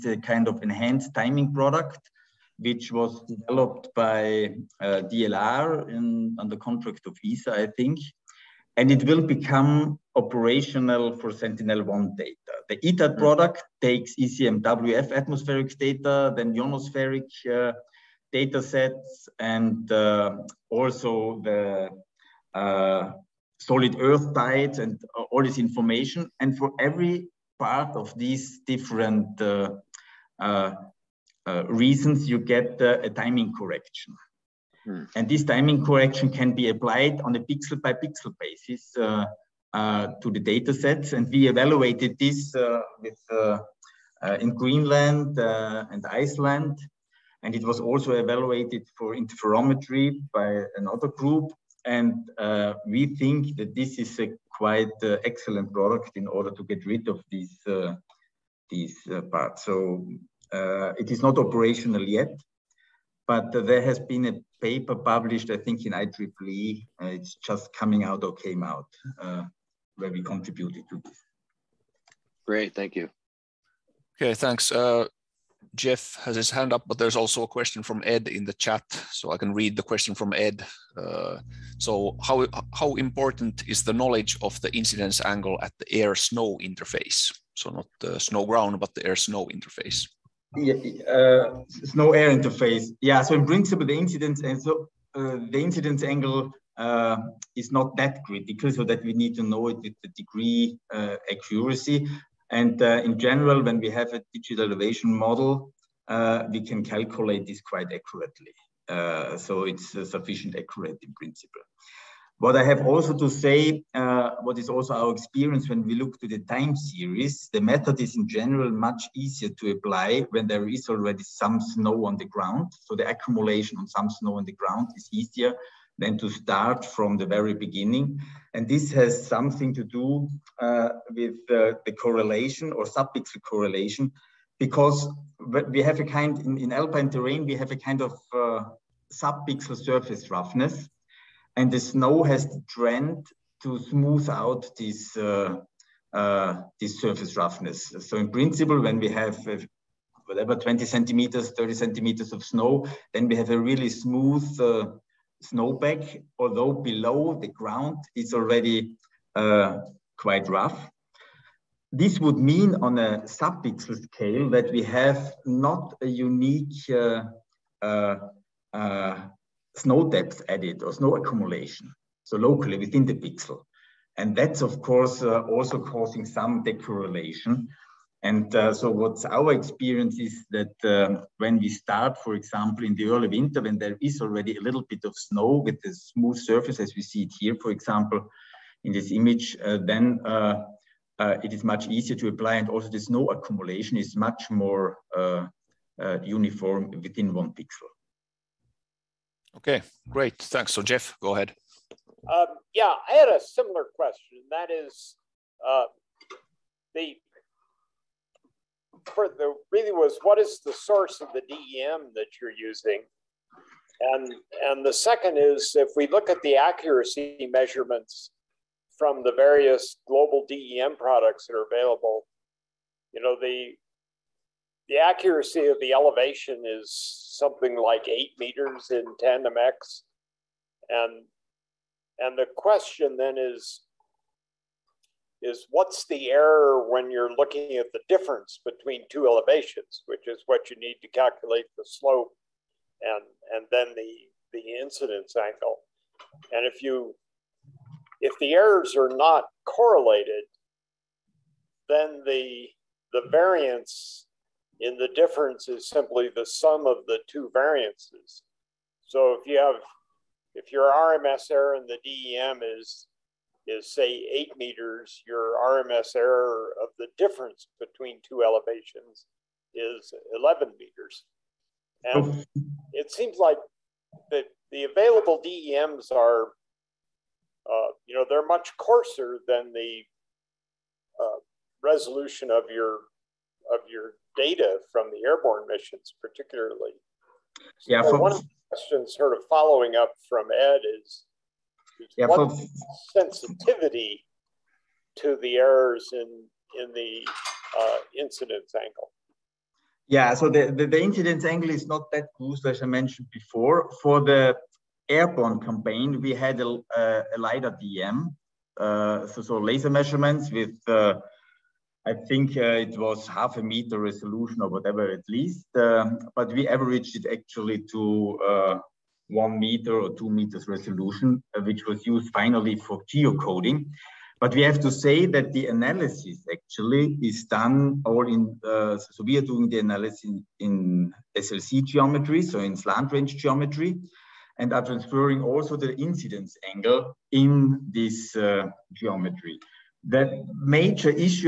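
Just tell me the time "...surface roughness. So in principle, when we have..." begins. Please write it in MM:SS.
02:27.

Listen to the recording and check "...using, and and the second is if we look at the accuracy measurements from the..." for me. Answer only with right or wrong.
right.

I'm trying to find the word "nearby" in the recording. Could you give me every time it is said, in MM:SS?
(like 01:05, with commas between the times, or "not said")
not said.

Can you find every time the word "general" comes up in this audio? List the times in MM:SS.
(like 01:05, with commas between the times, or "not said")
01:43, 01:58.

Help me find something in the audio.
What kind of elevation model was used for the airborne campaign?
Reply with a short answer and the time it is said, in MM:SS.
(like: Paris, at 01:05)
LiDAR DEM, at 05:07.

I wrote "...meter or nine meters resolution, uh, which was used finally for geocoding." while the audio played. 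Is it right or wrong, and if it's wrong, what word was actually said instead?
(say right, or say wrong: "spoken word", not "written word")
wrong: "two", not "nine".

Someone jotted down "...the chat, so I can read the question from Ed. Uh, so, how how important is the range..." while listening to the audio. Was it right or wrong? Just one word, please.
wrong.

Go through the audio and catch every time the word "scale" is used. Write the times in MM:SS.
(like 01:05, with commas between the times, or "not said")
02:44.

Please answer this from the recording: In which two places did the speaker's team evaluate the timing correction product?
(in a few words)
Greenland and Iceland.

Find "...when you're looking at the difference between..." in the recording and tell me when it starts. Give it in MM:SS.
03:56.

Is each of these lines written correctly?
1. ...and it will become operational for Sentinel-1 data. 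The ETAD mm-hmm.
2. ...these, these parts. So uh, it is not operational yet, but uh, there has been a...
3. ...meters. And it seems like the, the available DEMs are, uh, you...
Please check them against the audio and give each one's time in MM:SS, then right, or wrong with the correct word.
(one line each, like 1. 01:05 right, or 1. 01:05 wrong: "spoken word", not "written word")
1. 00:08 right
2. 00:57 right
3. 04:30 right.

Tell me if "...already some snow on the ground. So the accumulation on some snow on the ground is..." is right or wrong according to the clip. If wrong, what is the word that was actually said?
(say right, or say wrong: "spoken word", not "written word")
right.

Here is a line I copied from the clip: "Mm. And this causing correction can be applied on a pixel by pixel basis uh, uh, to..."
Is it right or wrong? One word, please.
wrong.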